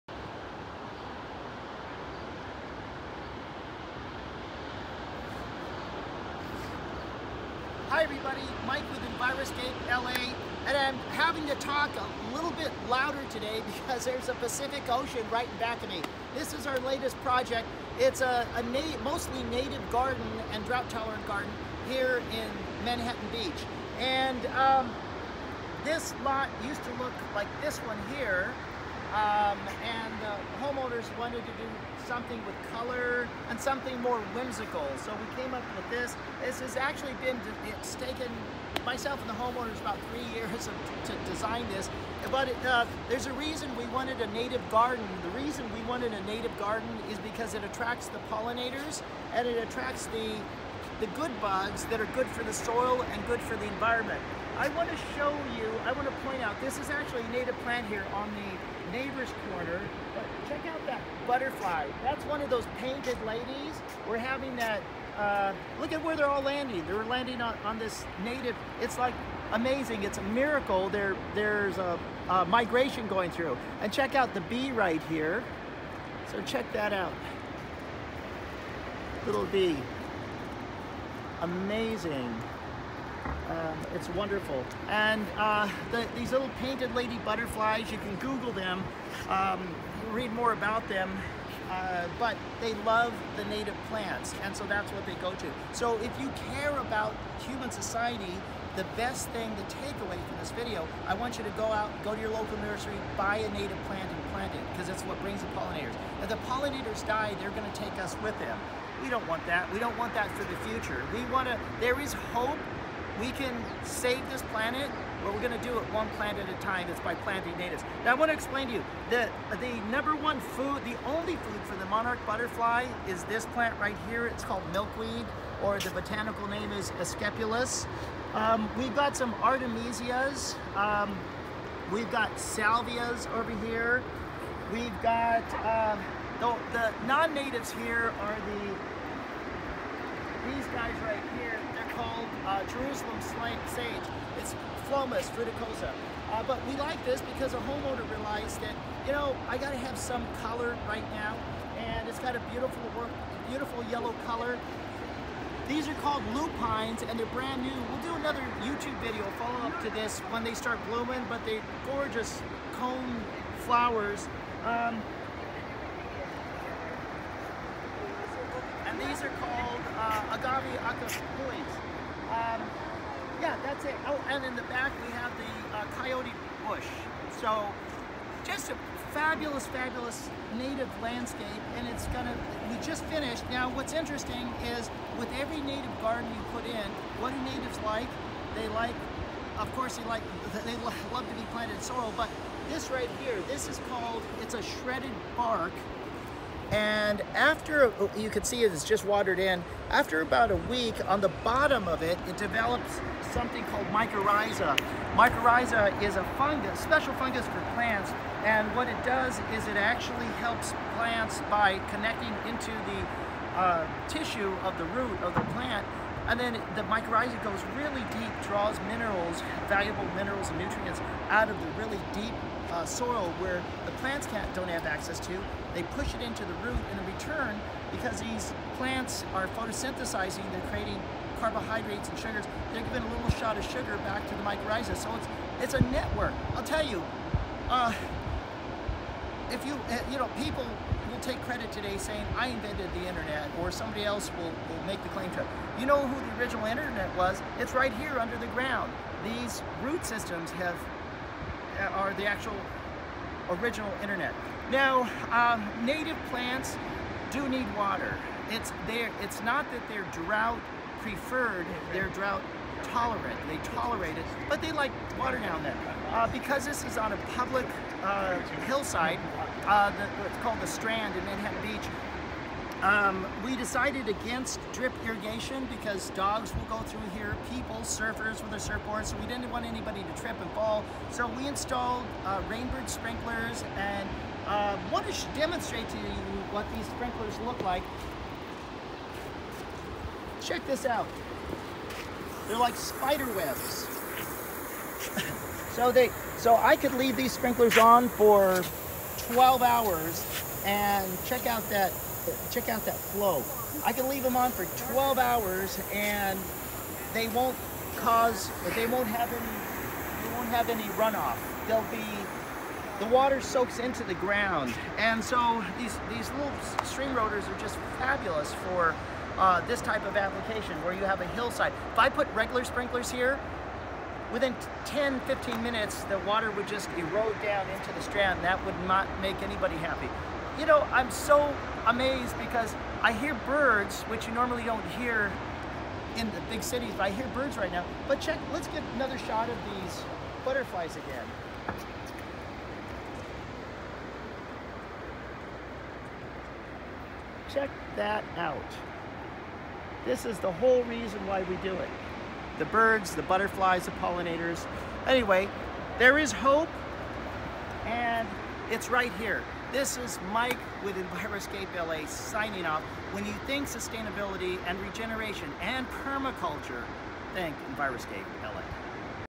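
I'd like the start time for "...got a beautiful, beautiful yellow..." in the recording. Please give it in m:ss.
2:32.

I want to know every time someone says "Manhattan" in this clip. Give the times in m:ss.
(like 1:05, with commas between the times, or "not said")
0:22, 4:31.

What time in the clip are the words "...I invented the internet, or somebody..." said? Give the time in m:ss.
4:02.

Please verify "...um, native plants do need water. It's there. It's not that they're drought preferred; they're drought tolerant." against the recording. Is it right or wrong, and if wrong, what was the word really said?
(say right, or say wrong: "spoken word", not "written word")
right.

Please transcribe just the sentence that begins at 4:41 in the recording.
So we installed uh, Rainbird sprinklers and uh, um, wanted to demonstrate to you what these sprinklers look like.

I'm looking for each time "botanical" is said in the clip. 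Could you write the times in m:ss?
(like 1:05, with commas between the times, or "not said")
2:05.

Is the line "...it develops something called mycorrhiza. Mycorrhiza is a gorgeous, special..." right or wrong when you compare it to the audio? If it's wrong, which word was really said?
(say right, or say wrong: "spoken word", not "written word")
wrong: "fungus", not "gorgeous".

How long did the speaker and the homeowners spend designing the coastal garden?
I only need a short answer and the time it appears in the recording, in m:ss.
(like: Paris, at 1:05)
3 years, at 0:39.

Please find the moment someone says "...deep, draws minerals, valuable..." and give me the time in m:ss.
3:38.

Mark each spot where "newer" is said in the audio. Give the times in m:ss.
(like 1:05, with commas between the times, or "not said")
not said.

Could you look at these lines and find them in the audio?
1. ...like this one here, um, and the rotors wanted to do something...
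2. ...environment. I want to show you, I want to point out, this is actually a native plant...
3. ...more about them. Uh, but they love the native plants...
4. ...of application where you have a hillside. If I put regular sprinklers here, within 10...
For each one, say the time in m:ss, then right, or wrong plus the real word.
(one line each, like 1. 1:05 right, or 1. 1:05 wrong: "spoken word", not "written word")
1. 0:27 wrong: "homeowners", not "rotors"
2. 0:53 right
3. 1:30 right
4. 5:20 right.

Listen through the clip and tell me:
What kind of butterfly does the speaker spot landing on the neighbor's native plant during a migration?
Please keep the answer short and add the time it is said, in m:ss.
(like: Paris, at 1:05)
painted lady, at 1:02.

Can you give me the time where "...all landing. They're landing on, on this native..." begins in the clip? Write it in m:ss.
1:06.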